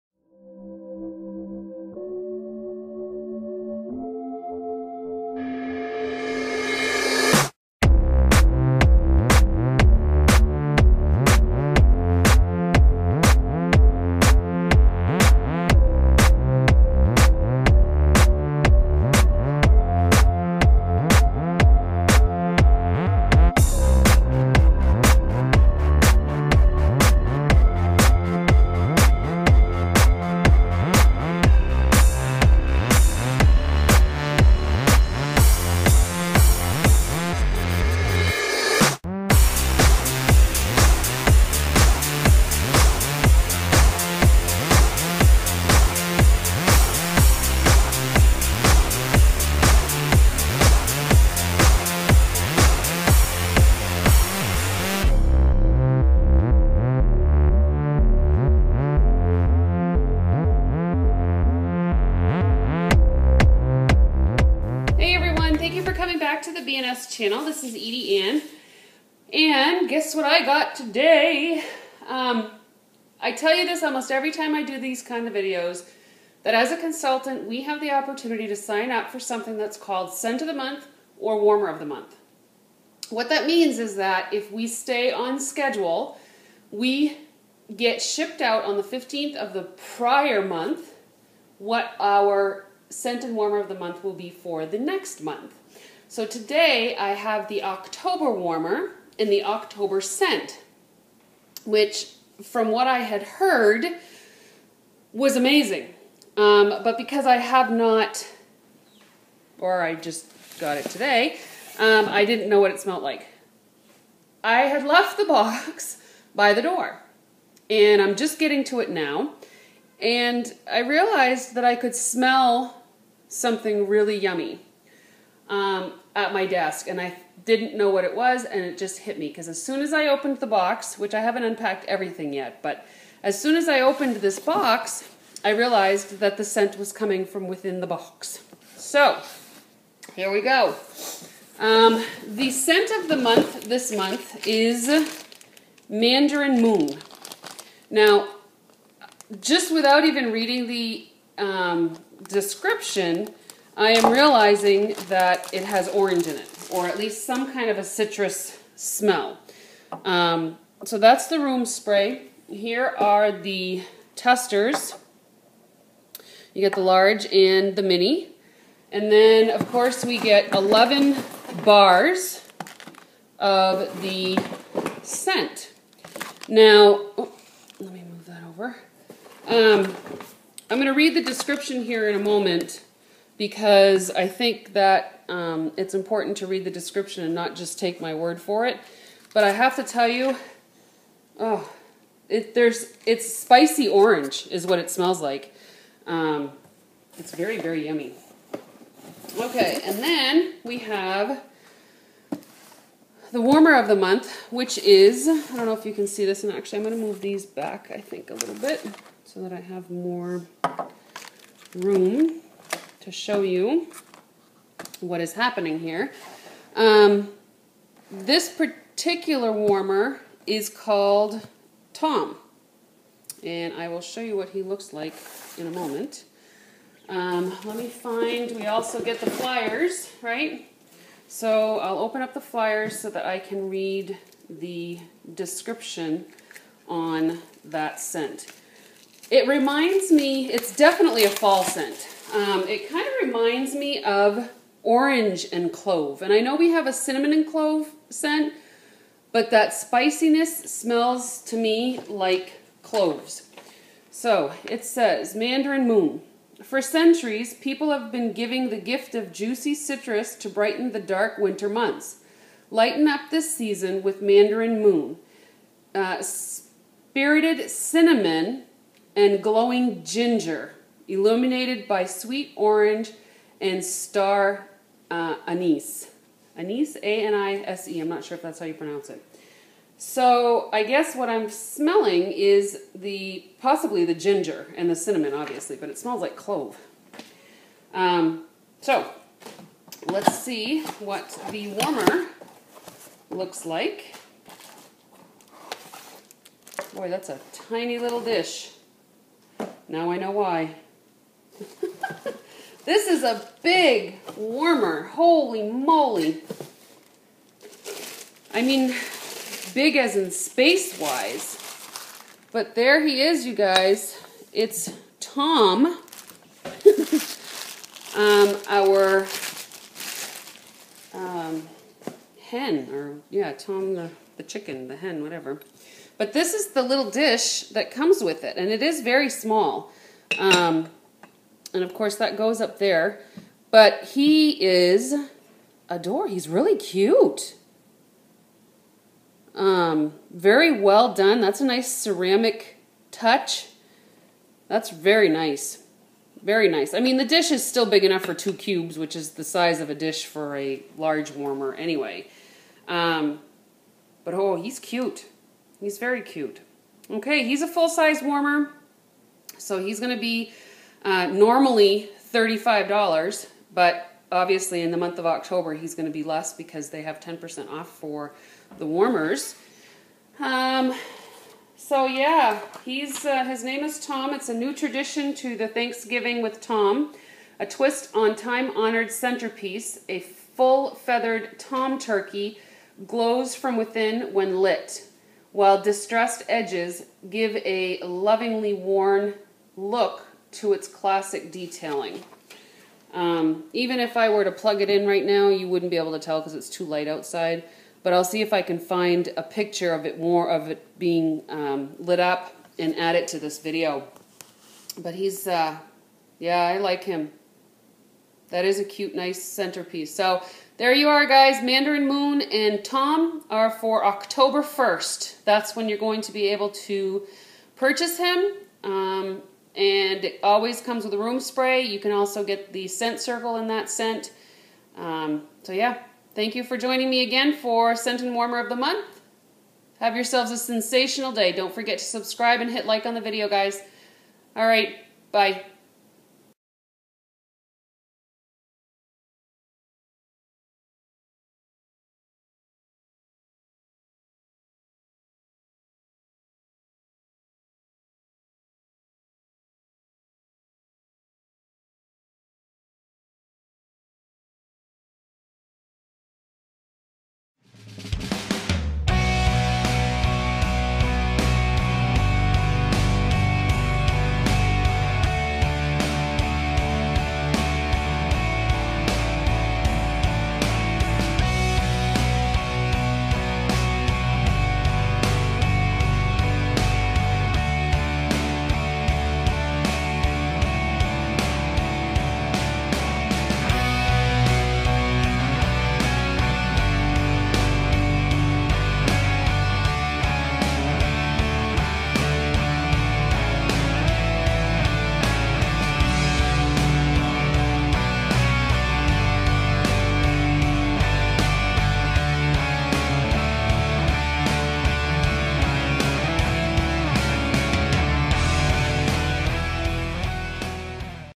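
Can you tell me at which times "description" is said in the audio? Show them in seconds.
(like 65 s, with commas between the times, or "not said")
152 s, 181 s, 186 s, 235 s.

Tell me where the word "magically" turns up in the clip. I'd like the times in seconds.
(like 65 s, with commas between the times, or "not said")
not said.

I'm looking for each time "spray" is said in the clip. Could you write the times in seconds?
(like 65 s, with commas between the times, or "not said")
161 s, 421 s.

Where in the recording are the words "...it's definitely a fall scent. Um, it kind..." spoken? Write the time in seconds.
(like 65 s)
240 s.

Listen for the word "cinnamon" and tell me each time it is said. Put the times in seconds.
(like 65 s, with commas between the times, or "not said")
246 s, 267 s, 284 s.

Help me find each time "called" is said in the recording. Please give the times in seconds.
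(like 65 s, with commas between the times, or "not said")
79 s, 220 s.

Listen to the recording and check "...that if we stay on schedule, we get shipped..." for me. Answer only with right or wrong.
right.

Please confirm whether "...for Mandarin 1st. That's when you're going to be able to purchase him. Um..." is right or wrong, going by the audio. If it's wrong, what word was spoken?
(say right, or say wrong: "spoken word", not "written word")
wrong: "October", not "Mandarin".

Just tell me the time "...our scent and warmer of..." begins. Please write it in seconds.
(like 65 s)
91 s.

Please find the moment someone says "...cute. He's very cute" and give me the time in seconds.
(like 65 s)
354 s.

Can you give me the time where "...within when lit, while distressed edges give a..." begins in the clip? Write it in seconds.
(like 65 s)
383 s.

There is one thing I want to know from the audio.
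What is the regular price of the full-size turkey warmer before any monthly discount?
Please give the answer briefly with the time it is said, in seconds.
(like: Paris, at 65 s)
$35, at 362 s.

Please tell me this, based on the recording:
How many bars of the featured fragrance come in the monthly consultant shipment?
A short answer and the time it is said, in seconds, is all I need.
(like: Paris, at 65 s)
11, at 170 s.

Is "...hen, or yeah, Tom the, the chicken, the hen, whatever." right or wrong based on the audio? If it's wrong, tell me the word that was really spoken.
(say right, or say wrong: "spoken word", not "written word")
right.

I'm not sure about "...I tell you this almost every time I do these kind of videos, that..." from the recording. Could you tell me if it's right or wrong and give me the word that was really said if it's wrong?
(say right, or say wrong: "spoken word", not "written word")
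right.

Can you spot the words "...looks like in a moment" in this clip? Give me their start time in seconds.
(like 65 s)
224 s.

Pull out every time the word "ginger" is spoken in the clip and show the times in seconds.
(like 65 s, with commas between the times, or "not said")
270 s, 284 s.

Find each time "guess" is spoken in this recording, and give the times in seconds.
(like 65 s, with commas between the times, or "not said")
69 s, 280 s.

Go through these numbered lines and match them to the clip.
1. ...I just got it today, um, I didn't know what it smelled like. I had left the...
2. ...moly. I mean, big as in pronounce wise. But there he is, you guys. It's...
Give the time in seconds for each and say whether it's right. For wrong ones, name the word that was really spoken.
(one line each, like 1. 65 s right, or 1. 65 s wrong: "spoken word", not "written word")
1. 109 s right
2. 305 s wrong: "space", not "pronounce".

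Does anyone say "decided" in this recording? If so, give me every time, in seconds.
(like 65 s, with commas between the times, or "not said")
not said.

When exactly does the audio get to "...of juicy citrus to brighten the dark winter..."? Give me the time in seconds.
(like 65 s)
259 s.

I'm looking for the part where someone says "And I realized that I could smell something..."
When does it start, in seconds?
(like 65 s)
120 s.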